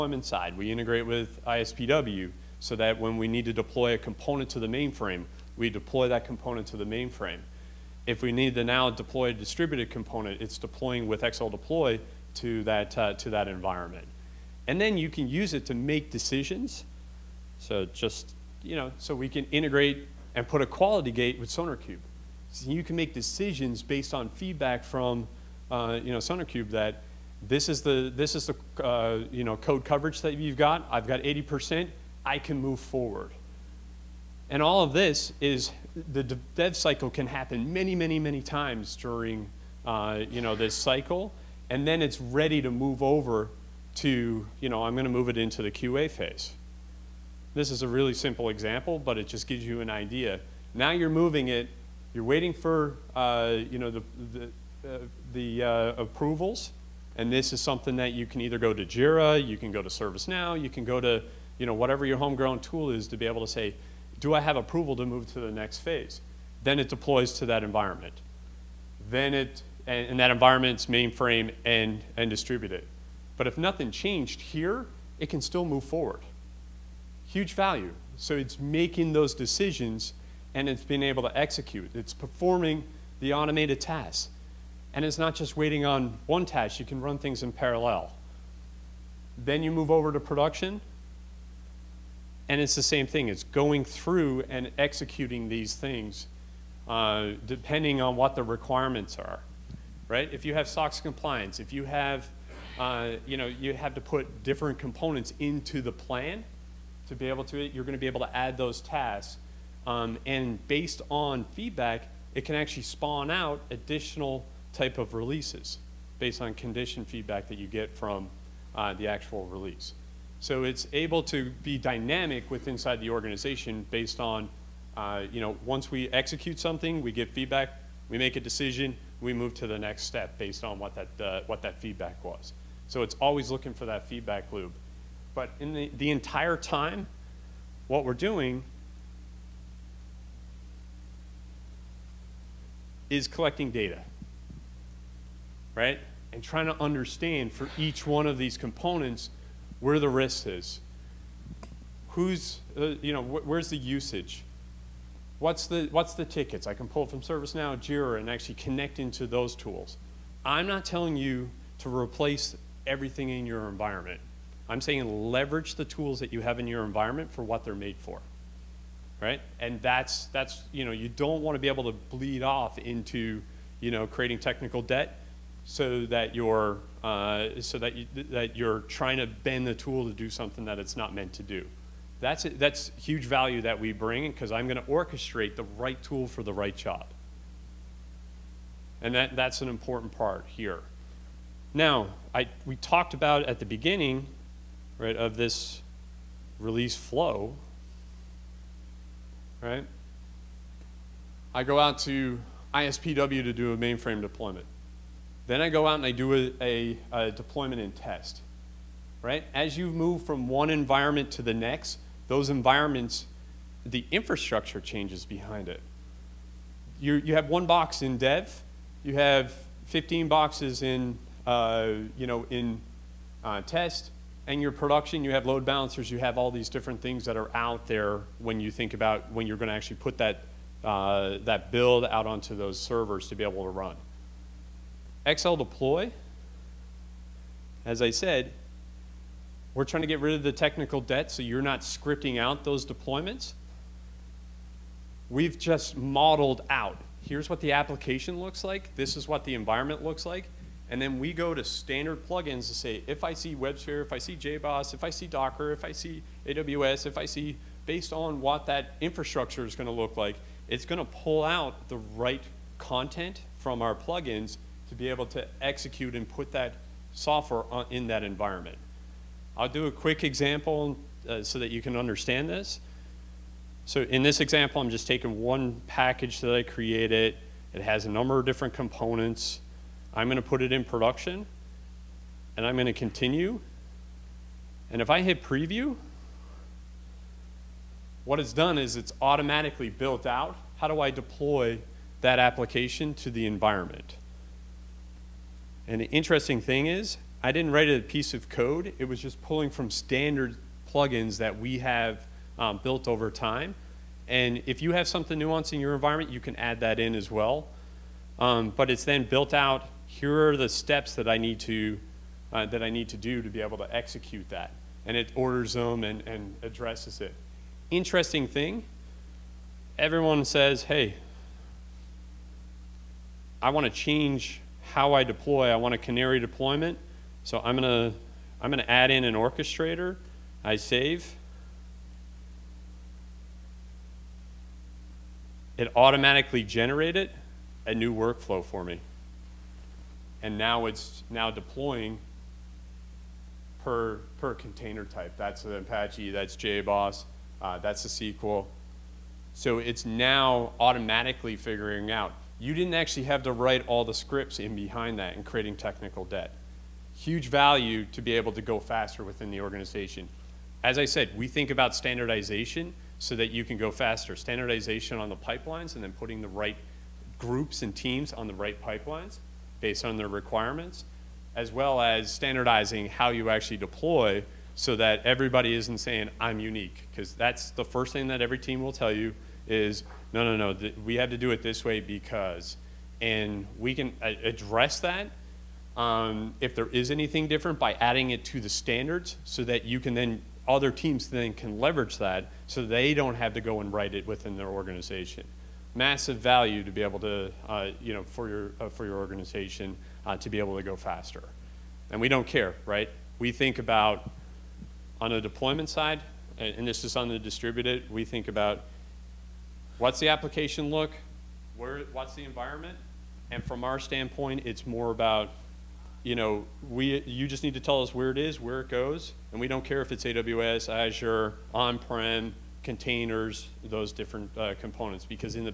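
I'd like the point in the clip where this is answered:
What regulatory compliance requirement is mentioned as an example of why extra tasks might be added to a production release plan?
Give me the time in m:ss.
1:40.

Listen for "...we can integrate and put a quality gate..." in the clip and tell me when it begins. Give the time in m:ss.
0:19.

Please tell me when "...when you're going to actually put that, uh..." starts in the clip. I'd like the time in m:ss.
3:49.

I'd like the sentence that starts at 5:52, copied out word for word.
You didn't actually have to write all the scripts in behind that and creating technical debt.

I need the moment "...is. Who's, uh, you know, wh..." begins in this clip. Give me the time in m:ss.
2:30.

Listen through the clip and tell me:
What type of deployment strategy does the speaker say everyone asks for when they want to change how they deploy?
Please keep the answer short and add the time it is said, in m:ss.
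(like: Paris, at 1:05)
Canary deployment, at 5:25.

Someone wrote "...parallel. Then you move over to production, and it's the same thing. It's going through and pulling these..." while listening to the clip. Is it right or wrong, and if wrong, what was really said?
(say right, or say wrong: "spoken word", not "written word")
wrong: "executing", not "pulling".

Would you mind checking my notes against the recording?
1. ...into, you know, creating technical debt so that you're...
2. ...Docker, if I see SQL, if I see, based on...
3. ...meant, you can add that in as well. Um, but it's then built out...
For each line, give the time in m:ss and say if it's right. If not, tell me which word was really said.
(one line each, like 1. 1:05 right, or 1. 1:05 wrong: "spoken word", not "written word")
1. 2:52 right
2. 4:15 wrong: "AWS", not "SQL"
3. 5:05 wrong: "environment", not "meant".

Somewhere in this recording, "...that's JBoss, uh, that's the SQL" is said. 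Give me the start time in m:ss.
5:46.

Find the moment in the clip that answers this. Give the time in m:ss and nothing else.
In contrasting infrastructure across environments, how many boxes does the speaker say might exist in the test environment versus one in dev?
3:39.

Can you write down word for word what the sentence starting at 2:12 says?
So it's always looking for that feedback loop.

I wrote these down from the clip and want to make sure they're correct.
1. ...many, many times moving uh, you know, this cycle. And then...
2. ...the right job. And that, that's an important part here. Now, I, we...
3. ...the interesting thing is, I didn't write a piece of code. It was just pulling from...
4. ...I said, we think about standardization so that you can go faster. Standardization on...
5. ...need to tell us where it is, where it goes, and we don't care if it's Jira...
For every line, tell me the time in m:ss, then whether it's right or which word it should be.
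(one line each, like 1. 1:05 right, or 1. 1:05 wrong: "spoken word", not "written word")
1. 0:37 wrong: "during", not "moving"
2. 3:06 right
3. 4:56 right
4. 6:00 right
5. 6:57 wrong: "AWS", not "Jira".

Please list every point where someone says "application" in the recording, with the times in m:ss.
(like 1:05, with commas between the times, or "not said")
4:07, 4:52, 6:50.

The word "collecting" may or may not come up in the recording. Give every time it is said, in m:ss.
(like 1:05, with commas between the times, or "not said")
2:23.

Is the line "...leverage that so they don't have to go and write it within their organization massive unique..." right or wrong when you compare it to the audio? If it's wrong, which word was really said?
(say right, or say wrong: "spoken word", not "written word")
wrong: "value", not "unique".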